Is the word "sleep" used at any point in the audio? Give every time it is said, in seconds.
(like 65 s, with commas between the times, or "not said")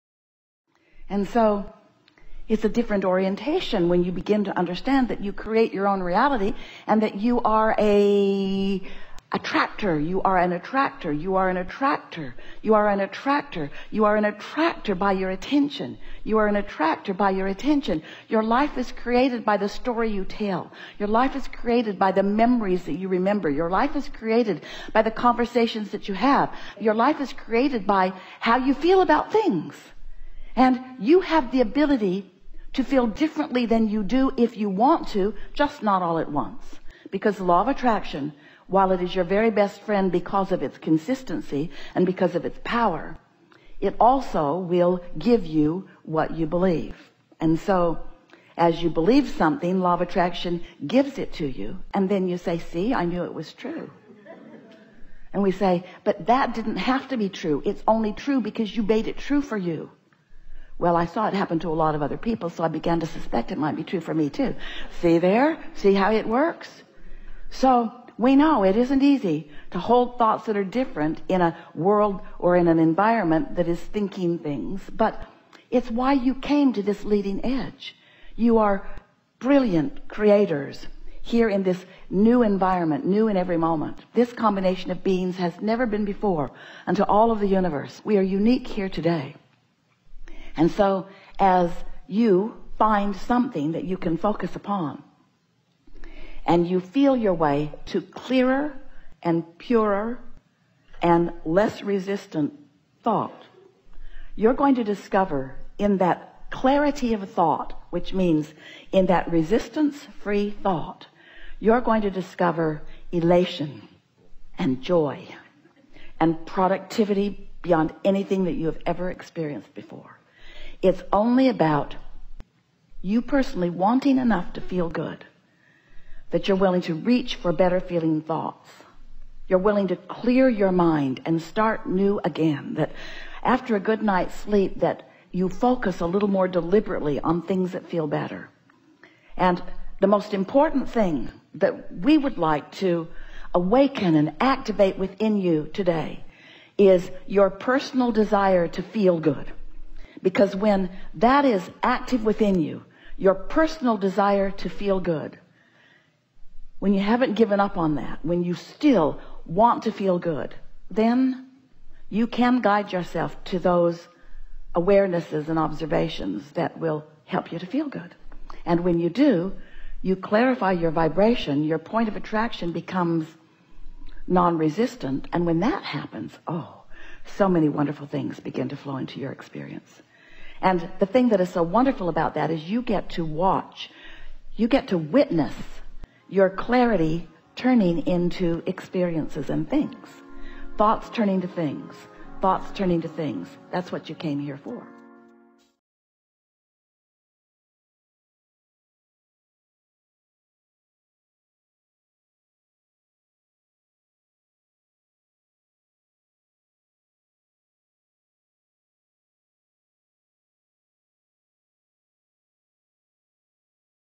134 s.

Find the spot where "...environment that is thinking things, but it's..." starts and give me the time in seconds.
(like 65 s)
72 s.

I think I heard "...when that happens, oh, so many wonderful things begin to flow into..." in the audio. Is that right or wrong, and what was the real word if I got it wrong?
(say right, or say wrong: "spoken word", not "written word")
right.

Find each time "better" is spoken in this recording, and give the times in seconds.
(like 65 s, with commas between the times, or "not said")
127 s, 138 s.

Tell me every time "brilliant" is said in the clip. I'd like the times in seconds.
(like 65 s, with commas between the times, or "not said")
79 s.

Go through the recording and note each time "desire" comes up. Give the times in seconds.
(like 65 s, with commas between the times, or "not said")
148 s, 153 s.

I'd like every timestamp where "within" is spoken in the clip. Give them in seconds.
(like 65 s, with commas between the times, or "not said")
144 s, 152 s.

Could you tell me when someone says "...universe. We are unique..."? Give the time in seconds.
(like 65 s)
87 s.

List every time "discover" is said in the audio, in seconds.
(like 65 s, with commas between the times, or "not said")
104 s, 112 s.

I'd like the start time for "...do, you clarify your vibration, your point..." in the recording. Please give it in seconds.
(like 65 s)
169 s.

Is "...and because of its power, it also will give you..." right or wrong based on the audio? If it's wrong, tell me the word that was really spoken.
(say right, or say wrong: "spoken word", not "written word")
right.